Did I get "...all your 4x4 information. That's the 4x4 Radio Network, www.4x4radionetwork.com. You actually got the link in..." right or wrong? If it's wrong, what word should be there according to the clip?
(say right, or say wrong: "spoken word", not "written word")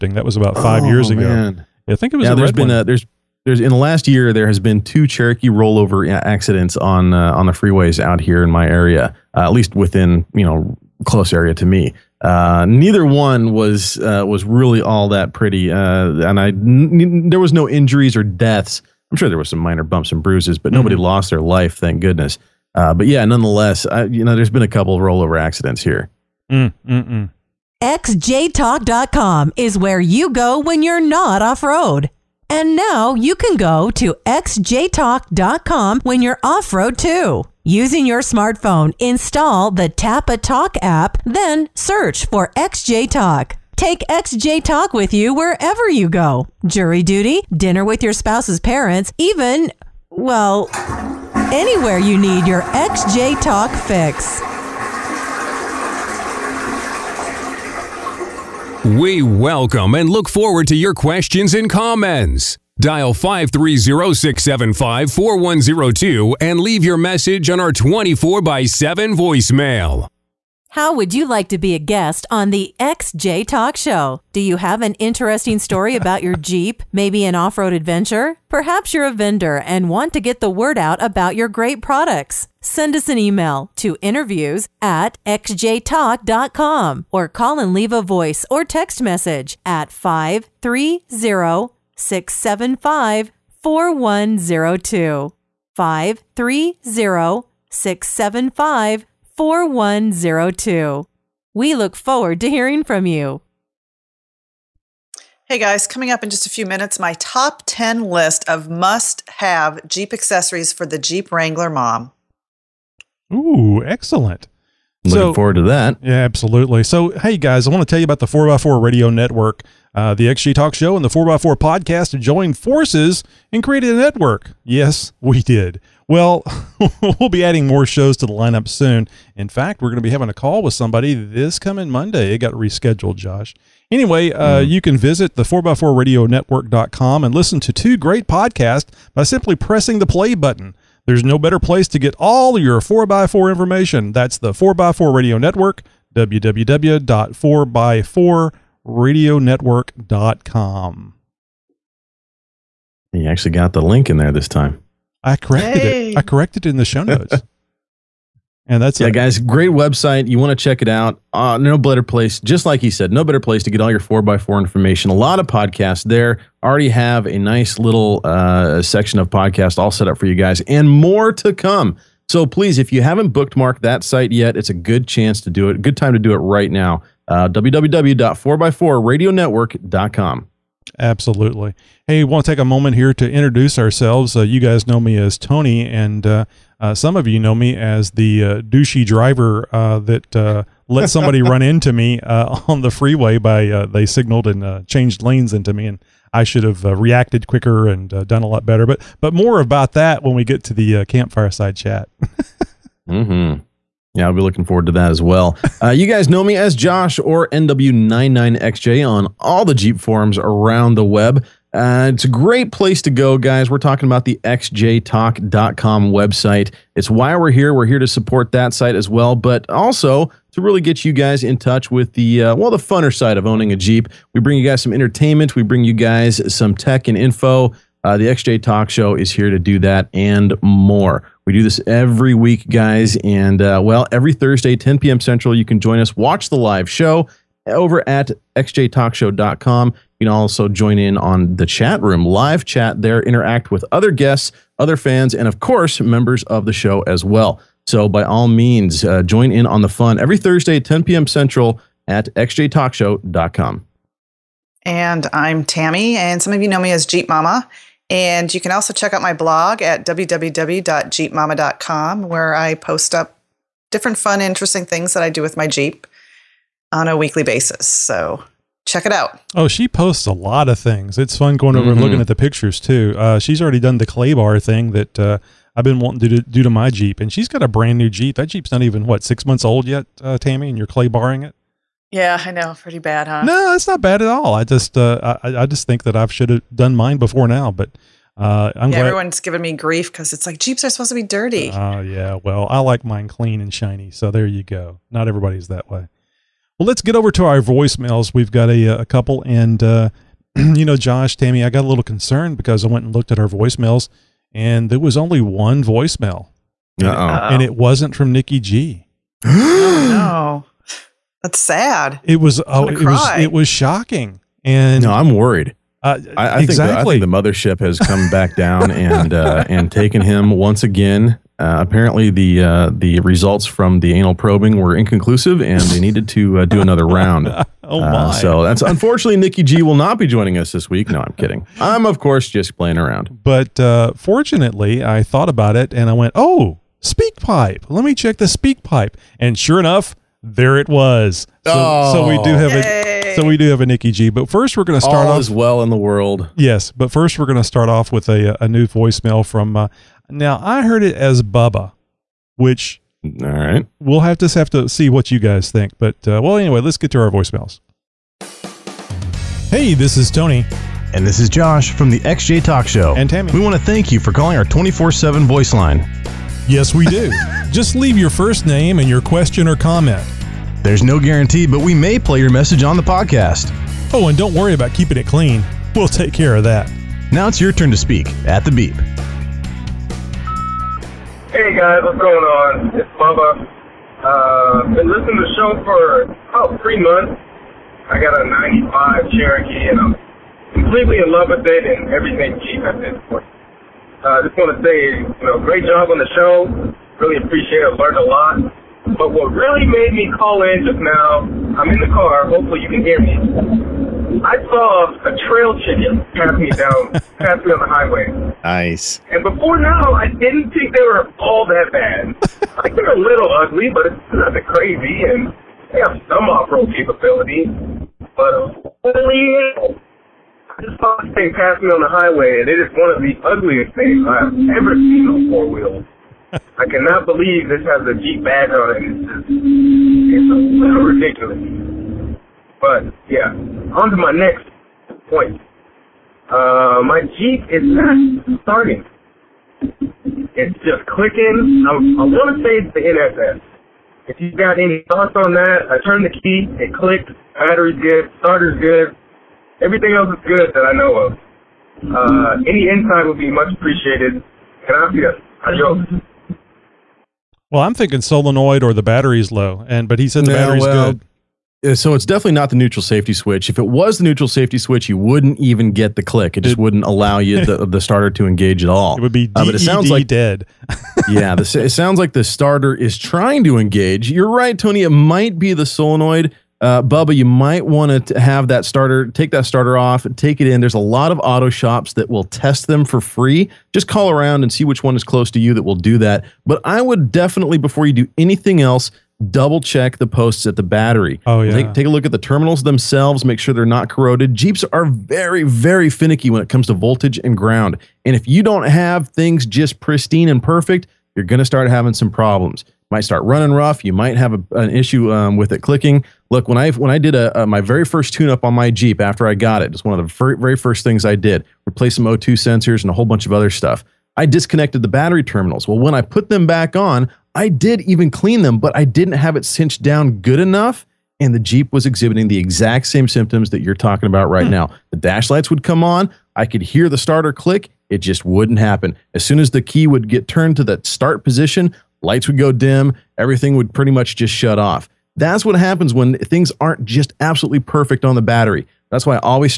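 right.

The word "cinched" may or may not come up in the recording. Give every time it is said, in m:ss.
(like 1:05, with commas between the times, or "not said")
8:39.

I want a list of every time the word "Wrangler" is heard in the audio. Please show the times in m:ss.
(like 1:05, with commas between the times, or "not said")
1:51.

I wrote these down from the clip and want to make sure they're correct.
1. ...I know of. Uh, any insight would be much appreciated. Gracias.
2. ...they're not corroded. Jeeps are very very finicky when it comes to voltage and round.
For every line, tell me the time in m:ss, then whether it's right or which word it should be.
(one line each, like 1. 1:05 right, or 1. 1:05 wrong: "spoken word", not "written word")
1. 7:30 right
2. 8:13 wrong: "ground", not "round".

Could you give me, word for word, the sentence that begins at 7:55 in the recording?
It might be the solenoid, uh, Bubba, you might want to have that starter, take that starter off, take it in.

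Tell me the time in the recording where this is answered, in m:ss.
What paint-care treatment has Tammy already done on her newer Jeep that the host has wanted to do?
4:34.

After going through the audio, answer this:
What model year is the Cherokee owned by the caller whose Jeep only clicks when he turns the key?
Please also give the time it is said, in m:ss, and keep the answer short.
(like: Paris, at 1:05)
1995, at 6:29.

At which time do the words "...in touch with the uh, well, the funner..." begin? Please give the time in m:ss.
3:41.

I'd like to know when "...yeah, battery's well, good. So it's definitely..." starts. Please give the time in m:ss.
7:40.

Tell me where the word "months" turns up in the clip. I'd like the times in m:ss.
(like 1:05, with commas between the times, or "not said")
4:39, 6:26.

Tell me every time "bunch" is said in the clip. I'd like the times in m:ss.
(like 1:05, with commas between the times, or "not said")
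8:33.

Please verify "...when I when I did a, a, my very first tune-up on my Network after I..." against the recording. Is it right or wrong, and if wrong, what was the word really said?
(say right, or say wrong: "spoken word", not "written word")
wrong: "Jeep", not "Network".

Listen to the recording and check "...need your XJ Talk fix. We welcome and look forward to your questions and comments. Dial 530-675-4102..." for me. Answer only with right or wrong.
right.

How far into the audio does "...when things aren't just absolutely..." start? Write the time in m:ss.
8:56.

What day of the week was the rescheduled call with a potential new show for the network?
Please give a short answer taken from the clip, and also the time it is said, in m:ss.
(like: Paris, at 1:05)
Monday, at 2:11.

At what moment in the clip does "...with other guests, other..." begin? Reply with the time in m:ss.
4:03.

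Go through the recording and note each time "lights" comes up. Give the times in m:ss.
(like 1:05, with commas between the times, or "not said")
8:45, 8:52.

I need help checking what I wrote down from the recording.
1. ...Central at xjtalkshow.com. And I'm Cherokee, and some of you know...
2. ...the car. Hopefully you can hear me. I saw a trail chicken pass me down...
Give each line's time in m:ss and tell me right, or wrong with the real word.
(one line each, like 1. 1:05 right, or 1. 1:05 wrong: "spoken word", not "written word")
1. 4:11 wrong: "Tammy", not "Cherokee"
2. 6:41 right.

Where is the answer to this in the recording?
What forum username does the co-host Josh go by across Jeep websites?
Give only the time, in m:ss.
3:27.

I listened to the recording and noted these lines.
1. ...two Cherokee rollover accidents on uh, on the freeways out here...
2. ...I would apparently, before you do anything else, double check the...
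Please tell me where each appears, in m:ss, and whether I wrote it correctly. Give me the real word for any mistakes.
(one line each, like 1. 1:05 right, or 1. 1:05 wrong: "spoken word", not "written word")
1. 0:04 right
2. 8:06 wrong: "definitely", not "apparently".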